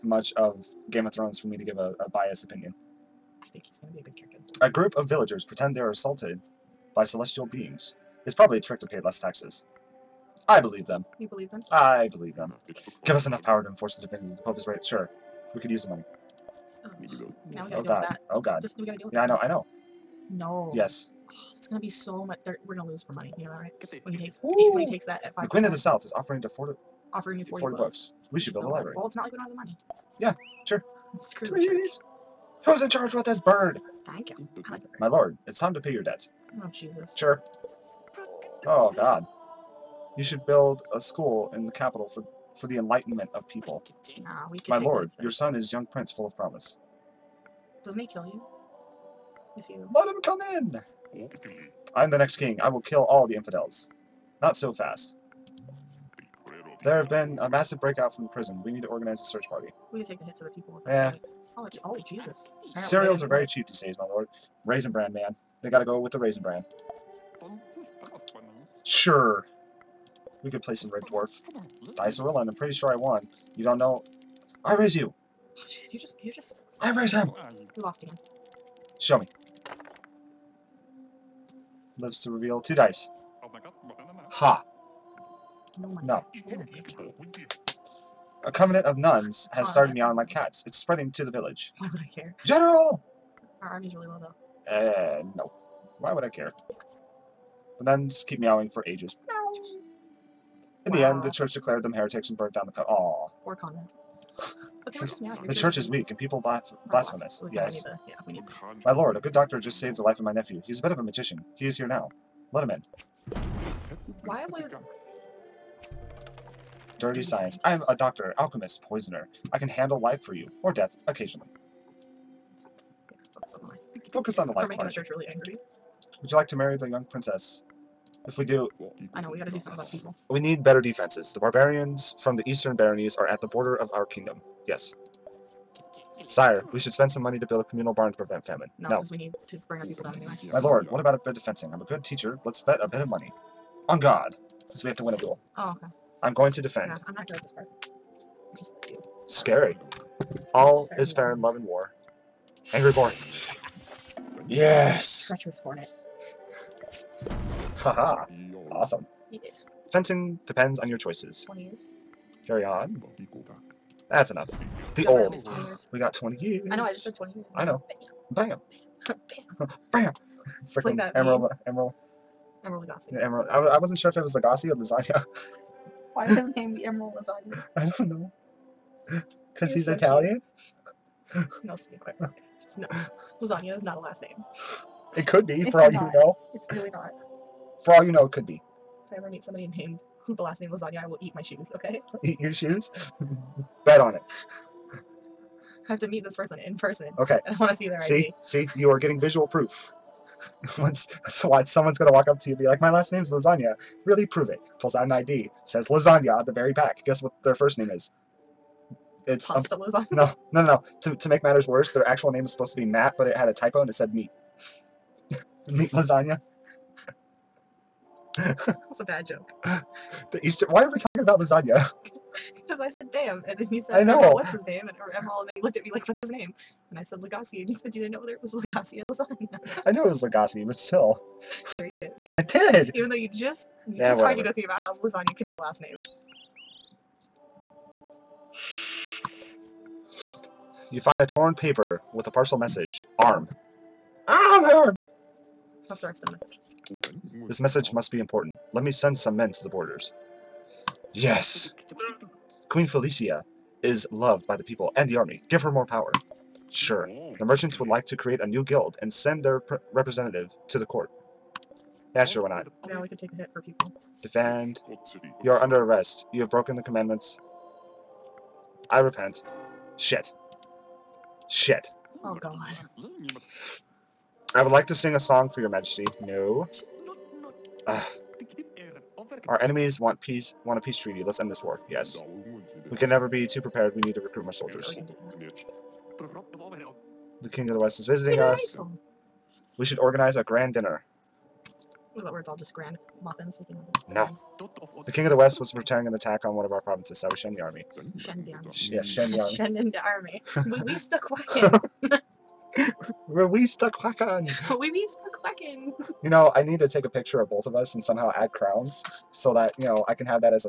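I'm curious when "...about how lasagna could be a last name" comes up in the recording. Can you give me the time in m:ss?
3:54.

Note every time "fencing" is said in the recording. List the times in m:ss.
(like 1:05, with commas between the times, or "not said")
2:21, 2:39.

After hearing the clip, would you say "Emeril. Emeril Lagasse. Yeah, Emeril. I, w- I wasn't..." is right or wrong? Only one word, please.
right.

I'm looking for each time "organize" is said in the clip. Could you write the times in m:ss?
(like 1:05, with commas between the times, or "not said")
0:58, 4:49.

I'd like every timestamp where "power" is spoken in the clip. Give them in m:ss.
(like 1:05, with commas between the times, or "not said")
0:13, 4:15.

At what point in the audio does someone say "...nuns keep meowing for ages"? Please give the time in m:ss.
1:37.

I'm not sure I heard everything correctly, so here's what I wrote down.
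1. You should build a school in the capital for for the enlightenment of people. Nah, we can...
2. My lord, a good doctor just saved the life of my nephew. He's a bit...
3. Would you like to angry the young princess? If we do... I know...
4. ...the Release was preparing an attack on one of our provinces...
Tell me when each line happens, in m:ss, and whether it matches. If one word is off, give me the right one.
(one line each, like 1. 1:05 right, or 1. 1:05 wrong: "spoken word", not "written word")
1. 0:40 right
2. 1:48 right
3. 2:06 wrong: "marry", not "angry"
4. 4:55 wrong: "West", not "Release".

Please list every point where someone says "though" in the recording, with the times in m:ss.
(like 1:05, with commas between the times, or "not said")
1:34, 3:53.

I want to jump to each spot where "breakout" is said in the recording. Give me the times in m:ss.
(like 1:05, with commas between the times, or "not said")
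0:57.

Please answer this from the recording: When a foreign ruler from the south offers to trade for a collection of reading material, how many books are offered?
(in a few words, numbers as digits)
40.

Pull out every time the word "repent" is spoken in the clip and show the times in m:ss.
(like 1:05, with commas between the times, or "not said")
4:28.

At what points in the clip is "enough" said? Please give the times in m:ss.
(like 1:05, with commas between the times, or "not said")
0:13, 2:44.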